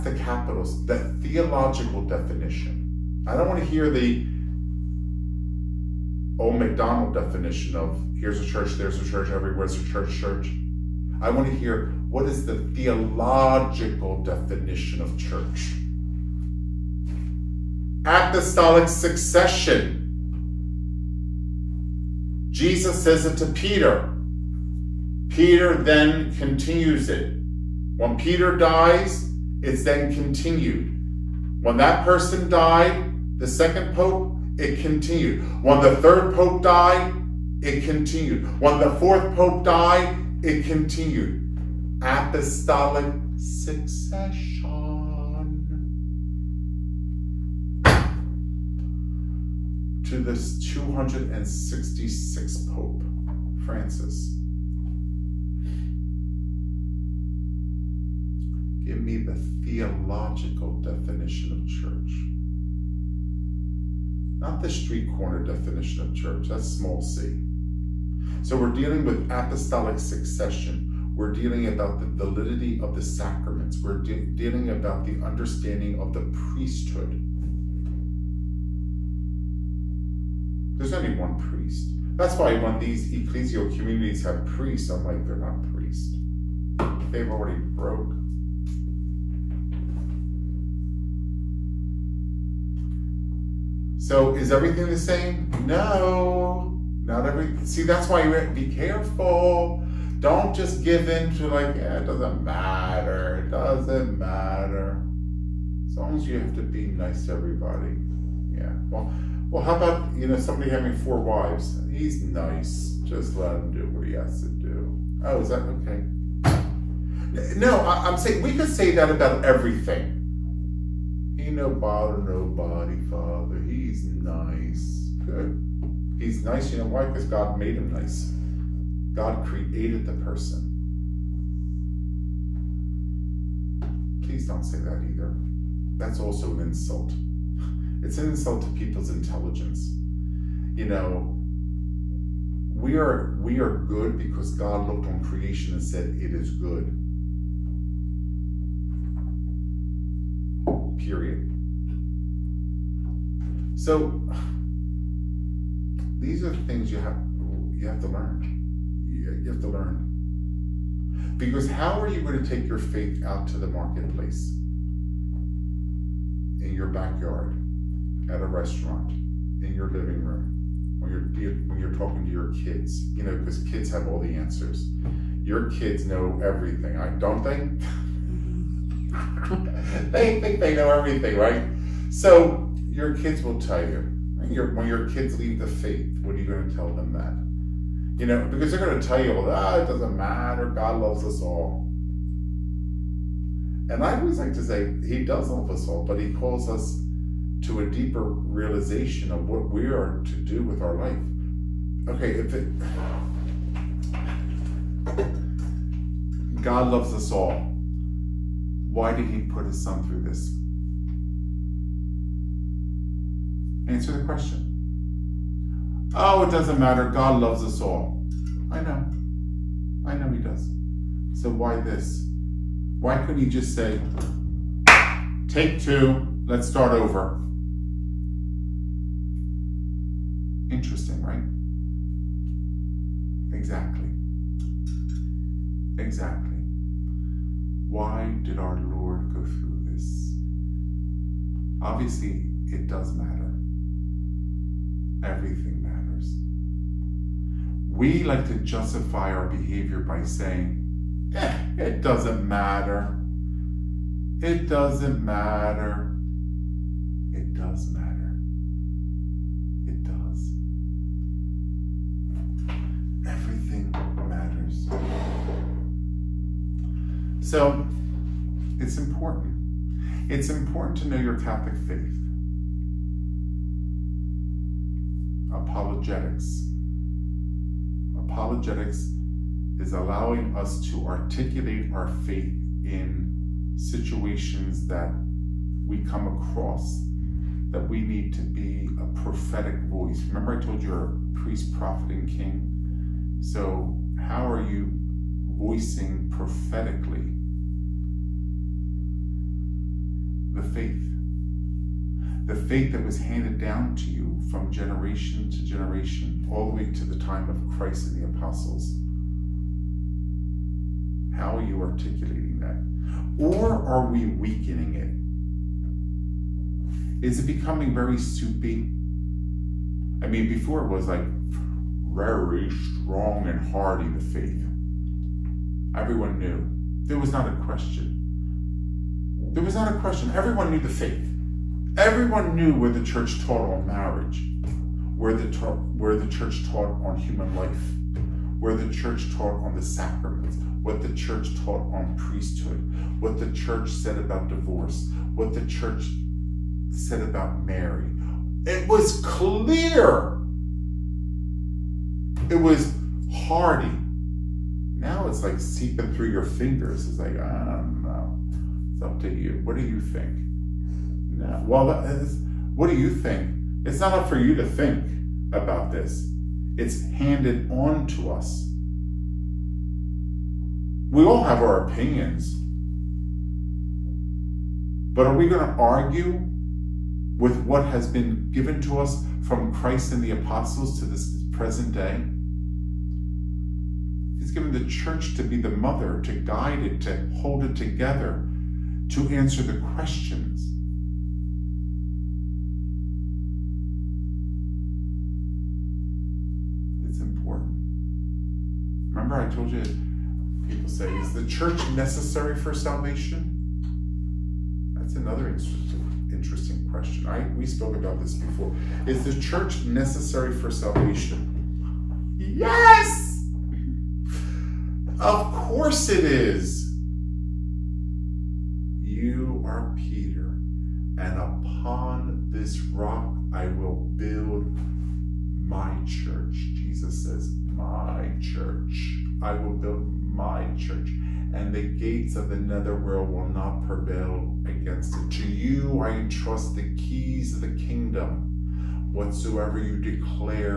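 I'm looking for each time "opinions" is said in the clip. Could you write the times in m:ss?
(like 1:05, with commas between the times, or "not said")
6:11.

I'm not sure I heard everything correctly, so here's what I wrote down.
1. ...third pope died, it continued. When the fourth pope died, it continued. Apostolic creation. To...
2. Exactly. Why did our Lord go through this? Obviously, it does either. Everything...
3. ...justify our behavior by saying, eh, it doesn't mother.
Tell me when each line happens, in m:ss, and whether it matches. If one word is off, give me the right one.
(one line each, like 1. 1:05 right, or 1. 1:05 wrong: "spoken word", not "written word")
1. 0:35 wrong: "succession", not "creation"
2. 3:55 wrong: "matter", not "either"
3. 4:08 wrong: "matter", not "mother".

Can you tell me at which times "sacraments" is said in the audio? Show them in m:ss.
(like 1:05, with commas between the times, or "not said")
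1:13, 5:39.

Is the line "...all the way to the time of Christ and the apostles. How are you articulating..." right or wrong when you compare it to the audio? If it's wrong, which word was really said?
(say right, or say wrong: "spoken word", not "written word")
right.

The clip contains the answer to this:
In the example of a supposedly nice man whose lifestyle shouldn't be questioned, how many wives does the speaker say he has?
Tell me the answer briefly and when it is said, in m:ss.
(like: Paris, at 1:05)
4, at 1:50.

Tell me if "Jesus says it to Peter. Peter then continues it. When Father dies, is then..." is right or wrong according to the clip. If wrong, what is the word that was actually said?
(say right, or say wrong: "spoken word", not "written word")
wrong: "Peter", not "Father".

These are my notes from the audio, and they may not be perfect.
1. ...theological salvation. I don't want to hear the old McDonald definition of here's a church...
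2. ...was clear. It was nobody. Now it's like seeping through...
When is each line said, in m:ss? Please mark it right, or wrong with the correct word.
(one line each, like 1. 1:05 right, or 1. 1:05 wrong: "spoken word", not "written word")
1. 0:00 wrong: "definition", not "salvation"
2. 5:48 wrong: "hardy", not "nobody".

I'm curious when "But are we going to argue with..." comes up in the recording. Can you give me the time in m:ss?
6:15.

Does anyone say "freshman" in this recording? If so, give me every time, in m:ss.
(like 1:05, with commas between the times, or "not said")
not said.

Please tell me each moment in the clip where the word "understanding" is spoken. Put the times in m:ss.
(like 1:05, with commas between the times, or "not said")
1:15.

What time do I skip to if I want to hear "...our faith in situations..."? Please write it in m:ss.
4:41.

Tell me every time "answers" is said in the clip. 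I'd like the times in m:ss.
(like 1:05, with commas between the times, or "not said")
2:54, 3:33, 6:29.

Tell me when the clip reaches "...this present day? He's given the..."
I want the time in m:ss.
6:21.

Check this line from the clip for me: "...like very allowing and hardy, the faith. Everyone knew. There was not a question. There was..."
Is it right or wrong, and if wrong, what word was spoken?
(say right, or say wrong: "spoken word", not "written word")
wrong: "strong", not "allowing".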